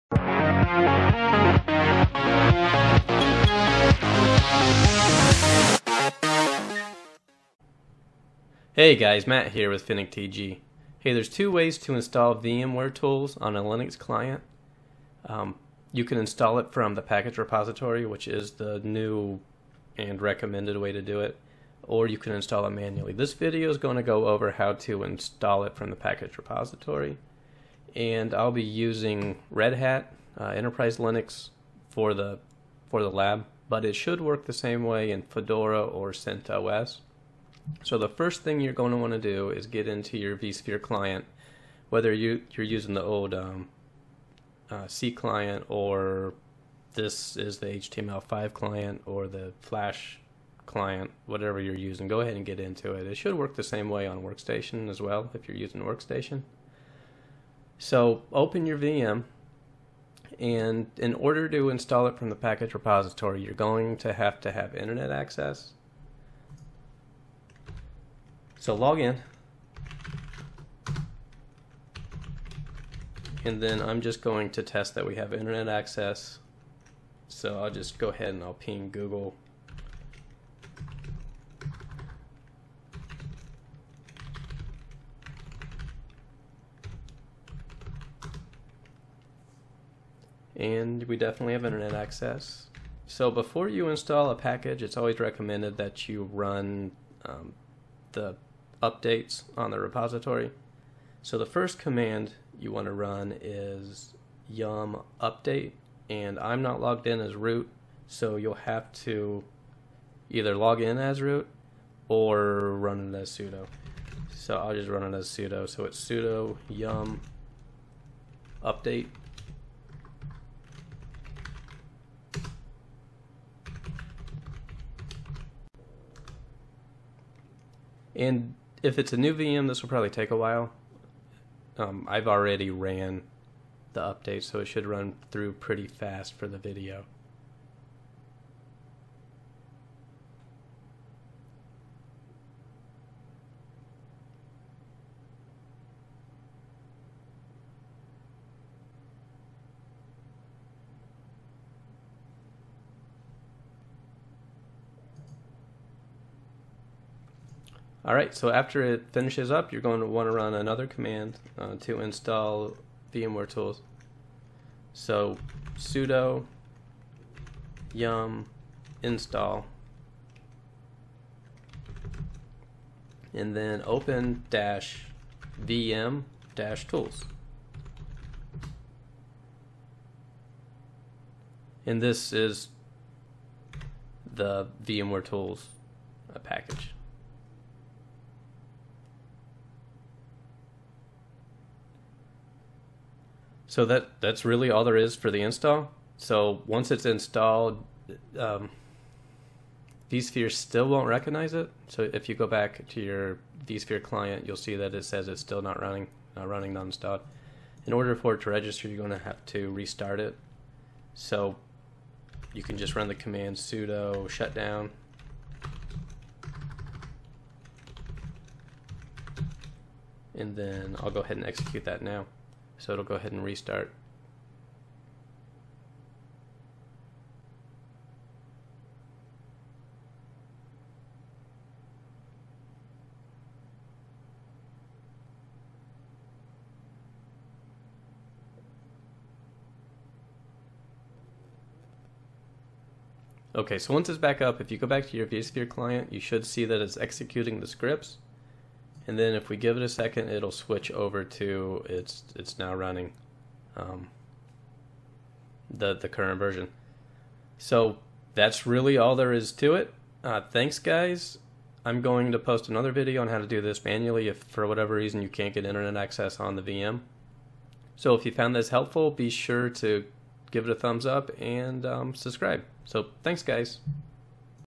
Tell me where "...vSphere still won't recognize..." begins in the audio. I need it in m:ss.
3:20.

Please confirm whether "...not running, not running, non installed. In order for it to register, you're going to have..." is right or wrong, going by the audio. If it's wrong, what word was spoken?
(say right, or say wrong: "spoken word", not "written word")
right.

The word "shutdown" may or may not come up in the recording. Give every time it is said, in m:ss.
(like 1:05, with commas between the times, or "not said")
3:34.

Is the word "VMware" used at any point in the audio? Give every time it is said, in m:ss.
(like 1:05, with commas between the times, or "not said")
0:12, 2:43, 3:04.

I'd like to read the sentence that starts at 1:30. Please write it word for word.
And we definitely have internet access.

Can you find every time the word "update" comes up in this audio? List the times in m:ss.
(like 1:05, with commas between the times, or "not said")
1:38, 1:45, 1:58, 2:14.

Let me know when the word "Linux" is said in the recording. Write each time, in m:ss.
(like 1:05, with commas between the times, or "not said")
0:13, 0:30.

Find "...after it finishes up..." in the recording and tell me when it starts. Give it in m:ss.
2:38.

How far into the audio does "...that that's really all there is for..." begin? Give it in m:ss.
3:13.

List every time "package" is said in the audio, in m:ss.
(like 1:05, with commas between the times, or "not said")
0:17, 0:25, 1:02, 1:34, 3:06.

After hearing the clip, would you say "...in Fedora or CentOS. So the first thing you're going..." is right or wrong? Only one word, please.
right.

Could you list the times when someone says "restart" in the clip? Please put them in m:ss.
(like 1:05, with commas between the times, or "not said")
3:29, 3:43.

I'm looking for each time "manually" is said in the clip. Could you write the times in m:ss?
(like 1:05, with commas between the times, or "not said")
0:22, 4:23.